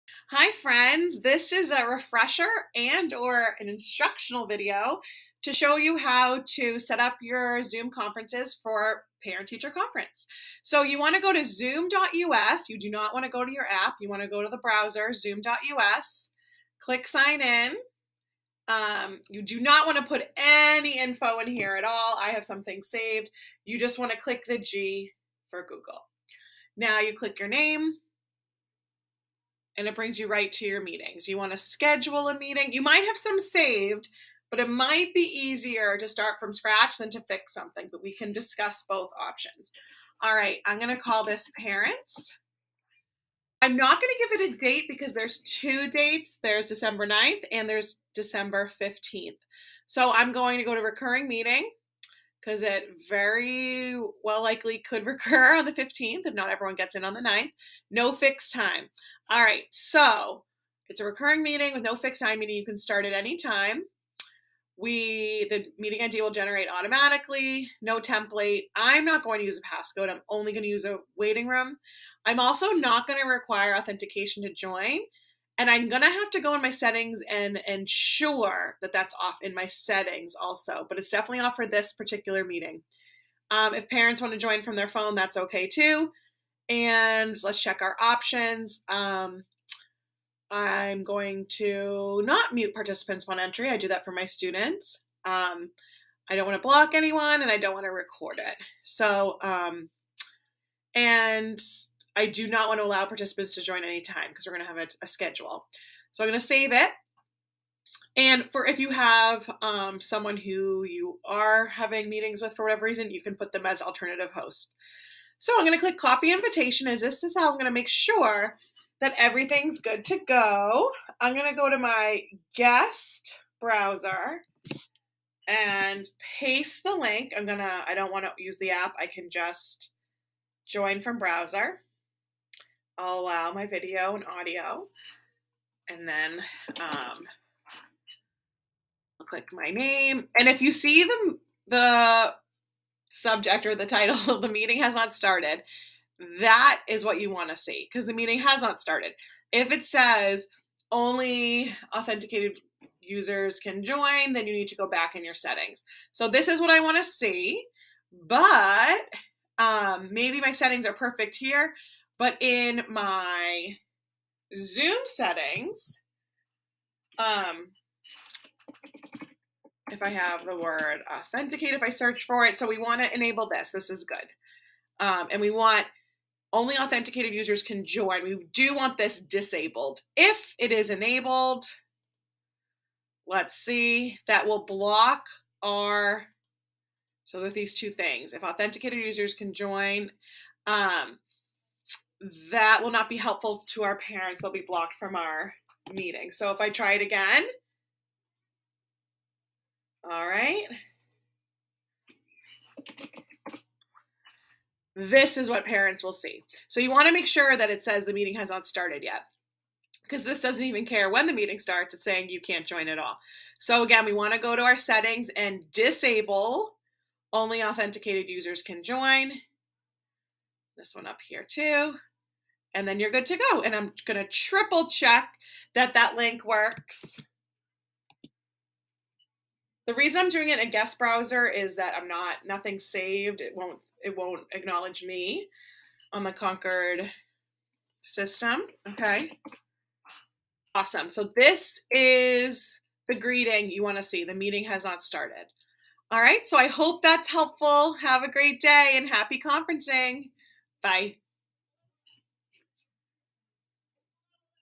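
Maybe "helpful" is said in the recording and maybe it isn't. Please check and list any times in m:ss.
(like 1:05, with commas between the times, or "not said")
3:13, 4:07.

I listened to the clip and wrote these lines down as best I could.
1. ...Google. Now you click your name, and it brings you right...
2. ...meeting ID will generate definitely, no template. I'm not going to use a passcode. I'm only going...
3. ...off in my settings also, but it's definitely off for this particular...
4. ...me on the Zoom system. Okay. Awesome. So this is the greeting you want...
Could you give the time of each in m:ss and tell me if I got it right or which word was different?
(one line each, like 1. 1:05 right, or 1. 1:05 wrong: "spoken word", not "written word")
1. 0:25 right
2. 1:05 wrong: "automatically", not "definitely"
3. 1:19 right
4. 3:55 wrong: "Concord", not "Zoom".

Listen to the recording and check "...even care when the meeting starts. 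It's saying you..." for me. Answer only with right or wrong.
right.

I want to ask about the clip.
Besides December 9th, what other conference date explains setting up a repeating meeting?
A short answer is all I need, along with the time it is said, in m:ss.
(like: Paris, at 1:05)
December 15th, at 0:48.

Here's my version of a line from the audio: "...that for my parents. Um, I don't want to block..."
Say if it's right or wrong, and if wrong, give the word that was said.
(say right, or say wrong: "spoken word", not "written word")
wrong: "students", not "parents".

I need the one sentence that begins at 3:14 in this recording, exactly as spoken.
They'll be blocked from our meeting.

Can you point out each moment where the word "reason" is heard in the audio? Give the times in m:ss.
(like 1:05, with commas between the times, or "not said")
1:52, 3:49.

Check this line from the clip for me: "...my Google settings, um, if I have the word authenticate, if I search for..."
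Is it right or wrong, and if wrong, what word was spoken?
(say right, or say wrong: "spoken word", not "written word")
wrong: "Zoom", not "Google".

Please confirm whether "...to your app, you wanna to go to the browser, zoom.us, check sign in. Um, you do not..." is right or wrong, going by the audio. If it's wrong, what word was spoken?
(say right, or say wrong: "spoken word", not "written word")
wrong: "click", not "check".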